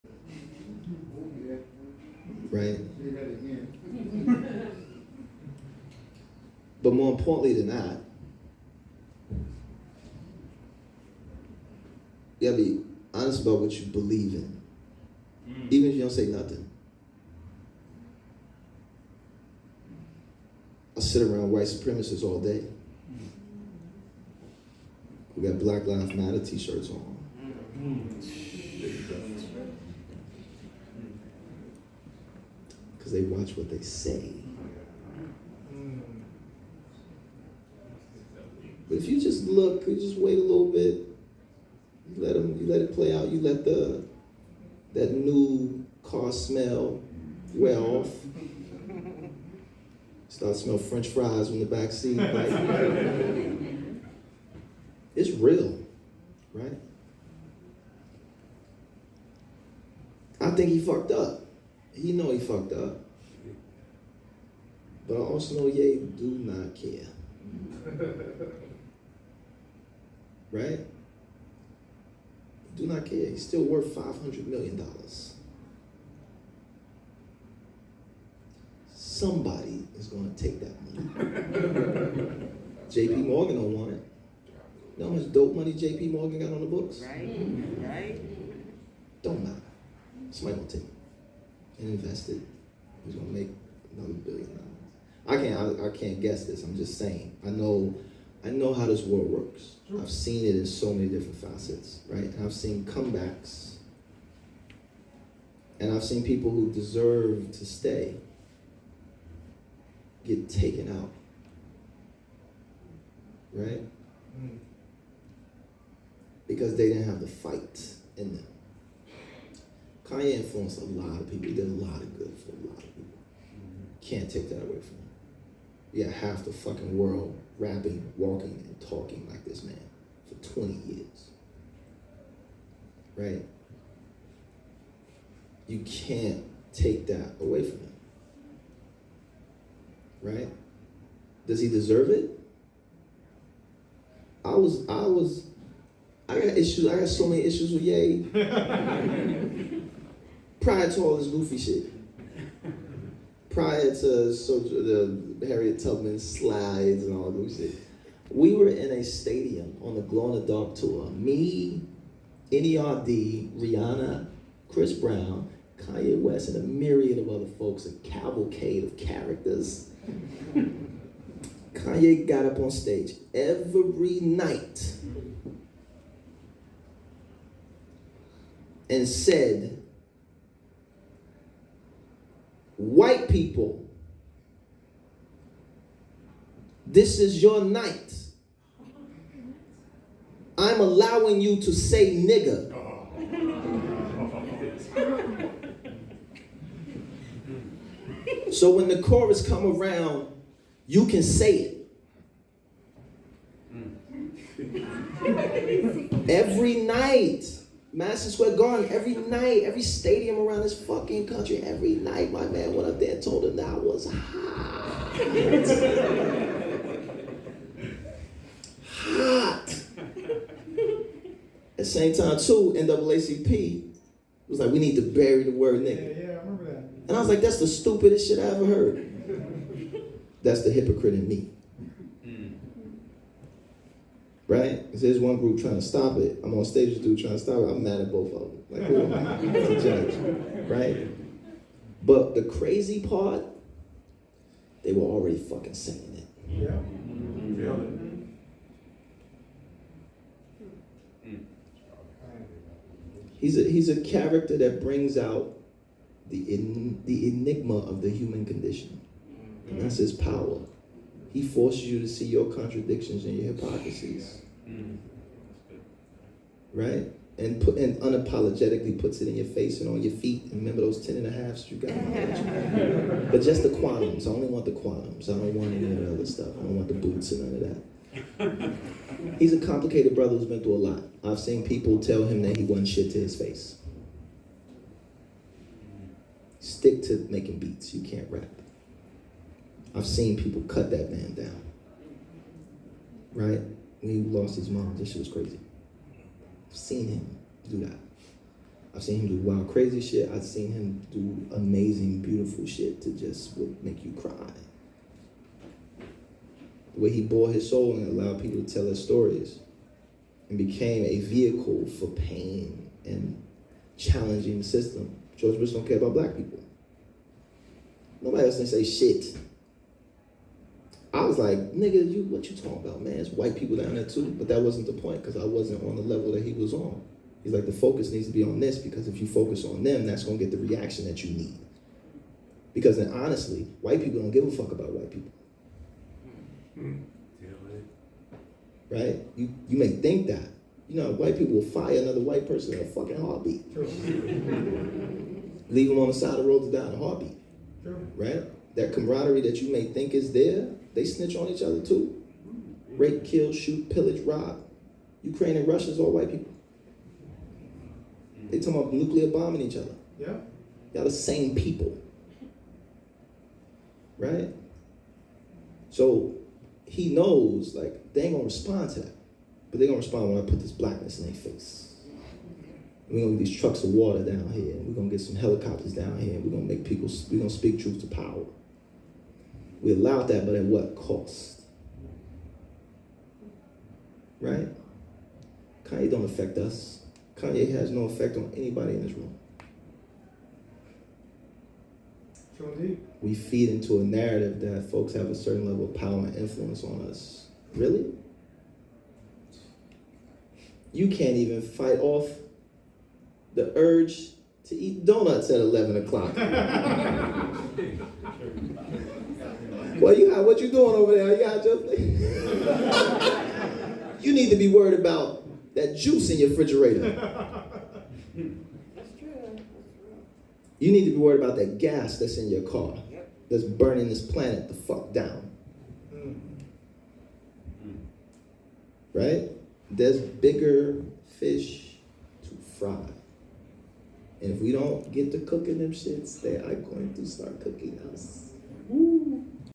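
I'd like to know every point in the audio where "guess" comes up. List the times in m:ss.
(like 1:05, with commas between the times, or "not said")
1:36.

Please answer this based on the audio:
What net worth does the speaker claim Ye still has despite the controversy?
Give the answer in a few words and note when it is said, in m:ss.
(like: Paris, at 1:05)
$500 million, at 1:13.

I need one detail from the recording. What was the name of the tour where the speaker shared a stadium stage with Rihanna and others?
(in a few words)
Glow in the Dark.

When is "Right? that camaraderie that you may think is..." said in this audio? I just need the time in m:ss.
5:48.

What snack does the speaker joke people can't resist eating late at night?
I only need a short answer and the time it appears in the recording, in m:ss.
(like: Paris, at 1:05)
Donuts, at 6:45.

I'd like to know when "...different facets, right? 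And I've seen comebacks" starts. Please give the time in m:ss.
1:41.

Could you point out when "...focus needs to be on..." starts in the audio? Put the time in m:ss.
5:27.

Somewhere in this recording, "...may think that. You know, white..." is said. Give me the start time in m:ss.
5:39.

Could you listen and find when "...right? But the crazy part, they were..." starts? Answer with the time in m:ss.
4:00.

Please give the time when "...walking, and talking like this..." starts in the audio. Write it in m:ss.
2:08.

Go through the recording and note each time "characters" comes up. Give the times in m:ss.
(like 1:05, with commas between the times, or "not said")
2:48, 4:14.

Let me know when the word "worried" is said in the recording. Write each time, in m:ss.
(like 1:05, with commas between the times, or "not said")
6:54, 7:01.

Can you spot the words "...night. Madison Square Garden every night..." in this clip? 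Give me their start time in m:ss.
3:26.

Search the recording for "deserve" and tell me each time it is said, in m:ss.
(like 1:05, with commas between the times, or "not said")
1:46, 2:21.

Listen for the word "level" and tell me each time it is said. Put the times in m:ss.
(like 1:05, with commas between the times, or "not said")
5:26, 6:35.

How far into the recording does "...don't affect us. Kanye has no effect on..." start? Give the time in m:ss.
6:26.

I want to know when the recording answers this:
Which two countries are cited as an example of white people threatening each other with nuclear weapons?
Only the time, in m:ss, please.
5:55.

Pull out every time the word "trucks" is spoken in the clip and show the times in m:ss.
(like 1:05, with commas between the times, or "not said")
6:13.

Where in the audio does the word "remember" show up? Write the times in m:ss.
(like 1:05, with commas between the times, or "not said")
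3:46, 4:30.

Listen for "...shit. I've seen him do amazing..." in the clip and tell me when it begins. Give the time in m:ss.
5:00.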